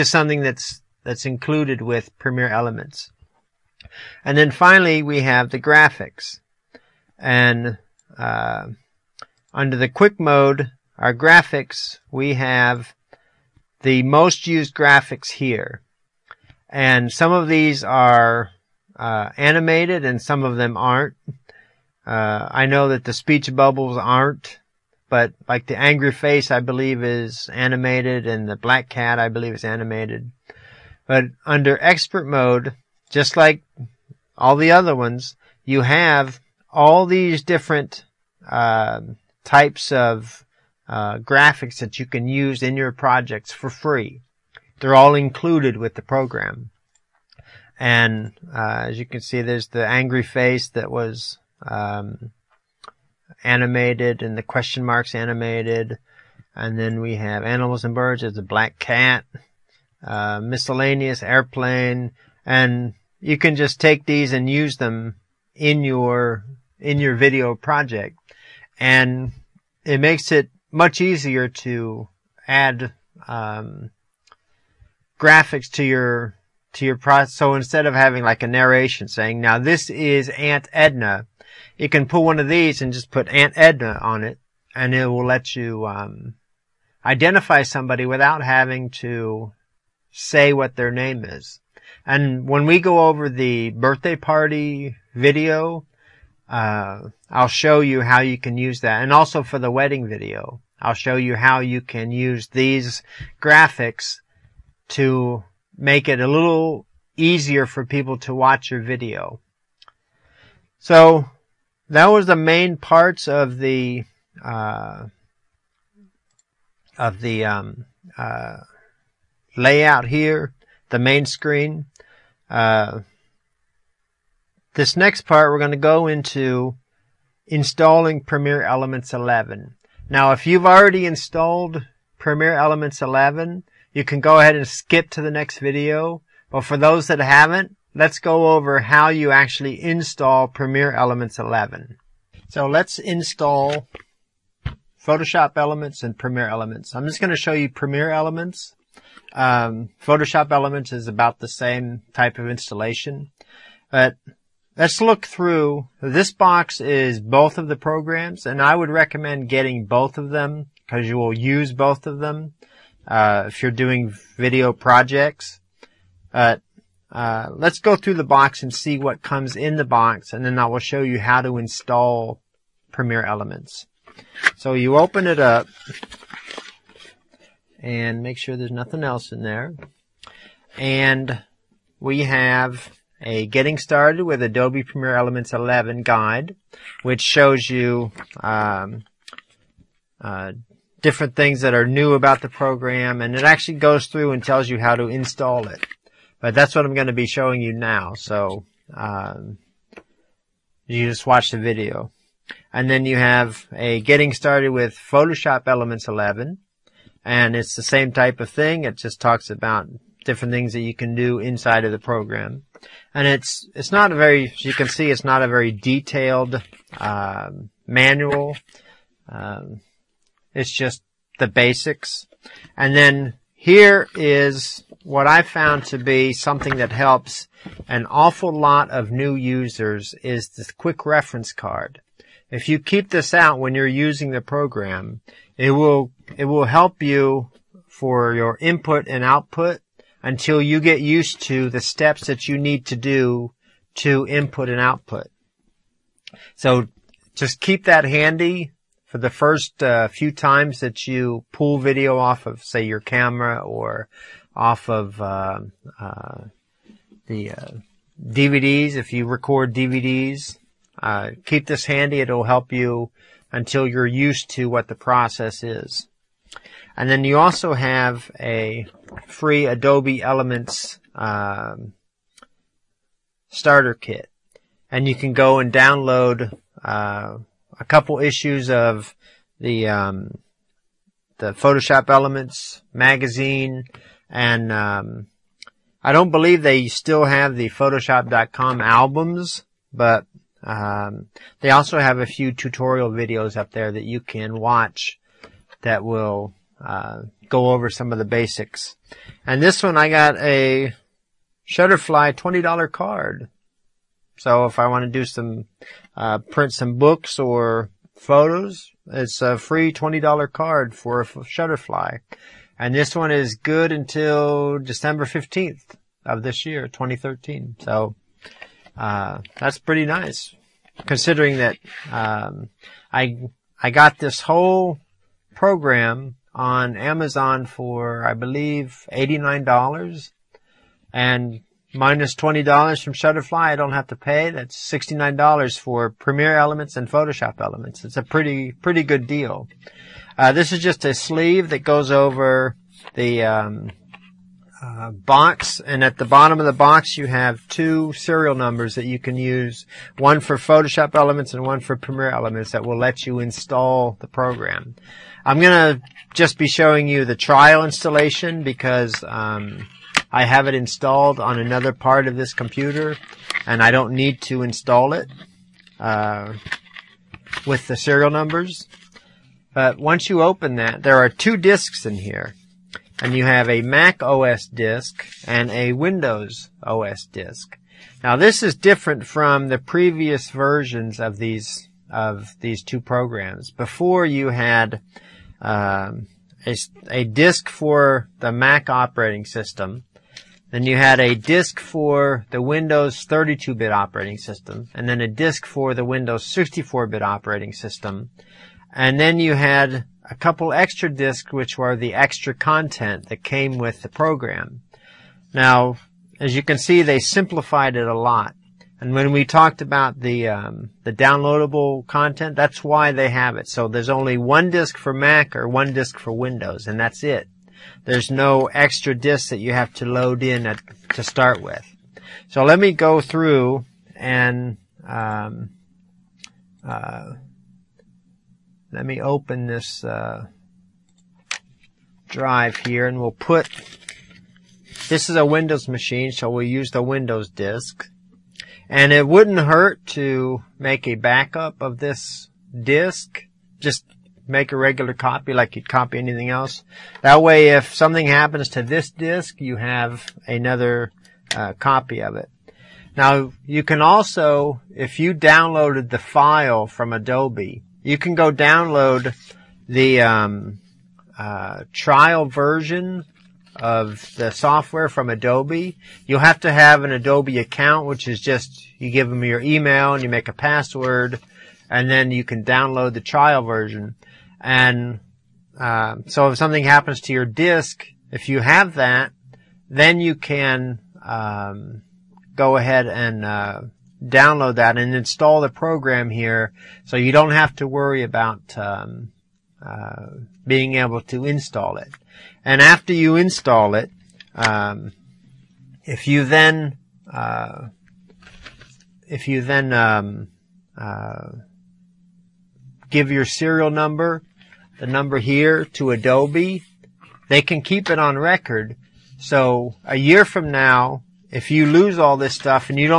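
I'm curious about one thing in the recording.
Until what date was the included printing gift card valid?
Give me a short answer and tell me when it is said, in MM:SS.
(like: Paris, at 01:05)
December 15th, at 05:14.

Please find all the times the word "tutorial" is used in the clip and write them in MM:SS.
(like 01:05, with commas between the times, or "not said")
04:52.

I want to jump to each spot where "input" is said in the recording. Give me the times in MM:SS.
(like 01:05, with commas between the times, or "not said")
03:58, 04:04.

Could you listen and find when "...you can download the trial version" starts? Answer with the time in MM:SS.
07:52.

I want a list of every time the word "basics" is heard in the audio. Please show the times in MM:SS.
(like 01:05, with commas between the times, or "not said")
03:41, 04:58.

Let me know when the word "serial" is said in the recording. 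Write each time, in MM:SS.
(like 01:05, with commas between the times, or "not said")
05:48, 06:07, 08:23.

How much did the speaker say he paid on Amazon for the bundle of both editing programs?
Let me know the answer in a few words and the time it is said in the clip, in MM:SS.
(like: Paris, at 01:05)
$89, at 05:29.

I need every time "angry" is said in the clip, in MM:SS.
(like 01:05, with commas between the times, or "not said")
00:25, 00:49.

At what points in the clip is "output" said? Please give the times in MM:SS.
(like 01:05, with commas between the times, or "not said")
03:59, 04:04.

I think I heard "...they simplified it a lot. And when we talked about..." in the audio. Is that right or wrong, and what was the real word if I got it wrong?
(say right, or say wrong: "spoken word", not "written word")
right.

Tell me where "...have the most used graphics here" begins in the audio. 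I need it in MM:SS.
00:12.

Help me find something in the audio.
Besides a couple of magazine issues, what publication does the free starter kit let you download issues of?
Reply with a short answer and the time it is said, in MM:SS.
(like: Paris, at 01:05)
Photoshop Elements magazine, at 04:41.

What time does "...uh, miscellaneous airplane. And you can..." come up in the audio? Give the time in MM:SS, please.
01:00.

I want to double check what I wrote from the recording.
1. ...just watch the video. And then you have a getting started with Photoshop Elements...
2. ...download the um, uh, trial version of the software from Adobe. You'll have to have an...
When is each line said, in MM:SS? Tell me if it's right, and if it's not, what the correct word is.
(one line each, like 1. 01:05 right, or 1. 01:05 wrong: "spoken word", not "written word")
1. 03:21 right
2. 07:38 right.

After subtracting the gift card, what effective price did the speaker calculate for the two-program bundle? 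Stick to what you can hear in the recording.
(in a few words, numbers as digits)
$69.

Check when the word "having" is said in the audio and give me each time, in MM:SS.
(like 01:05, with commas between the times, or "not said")
01:17, 01:28.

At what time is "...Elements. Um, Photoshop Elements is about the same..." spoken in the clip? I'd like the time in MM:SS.
02:28.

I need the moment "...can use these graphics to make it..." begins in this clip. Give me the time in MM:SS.
01:41.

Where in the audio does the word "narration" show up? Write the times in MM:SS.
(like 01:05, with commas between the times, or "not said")
01:18.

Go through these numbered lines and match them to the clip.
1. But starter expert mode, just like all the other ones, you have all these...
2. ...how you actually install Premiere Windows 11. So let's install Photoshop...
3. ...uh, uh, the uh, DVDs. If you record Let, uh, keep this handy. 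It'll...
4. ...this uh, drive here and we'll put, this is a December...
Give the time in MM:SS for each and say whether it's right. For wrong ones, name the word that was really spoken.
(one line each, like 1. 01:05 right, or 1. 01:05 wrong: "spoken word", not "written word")
1. 00:31 wrong: "under", not "starter"
2. 02:18 wrong: "Elements", not "Windows"
3. 04:15 wrong: "DVDs", not "Let"
4. 07:09 wrong: "Windows", not "December".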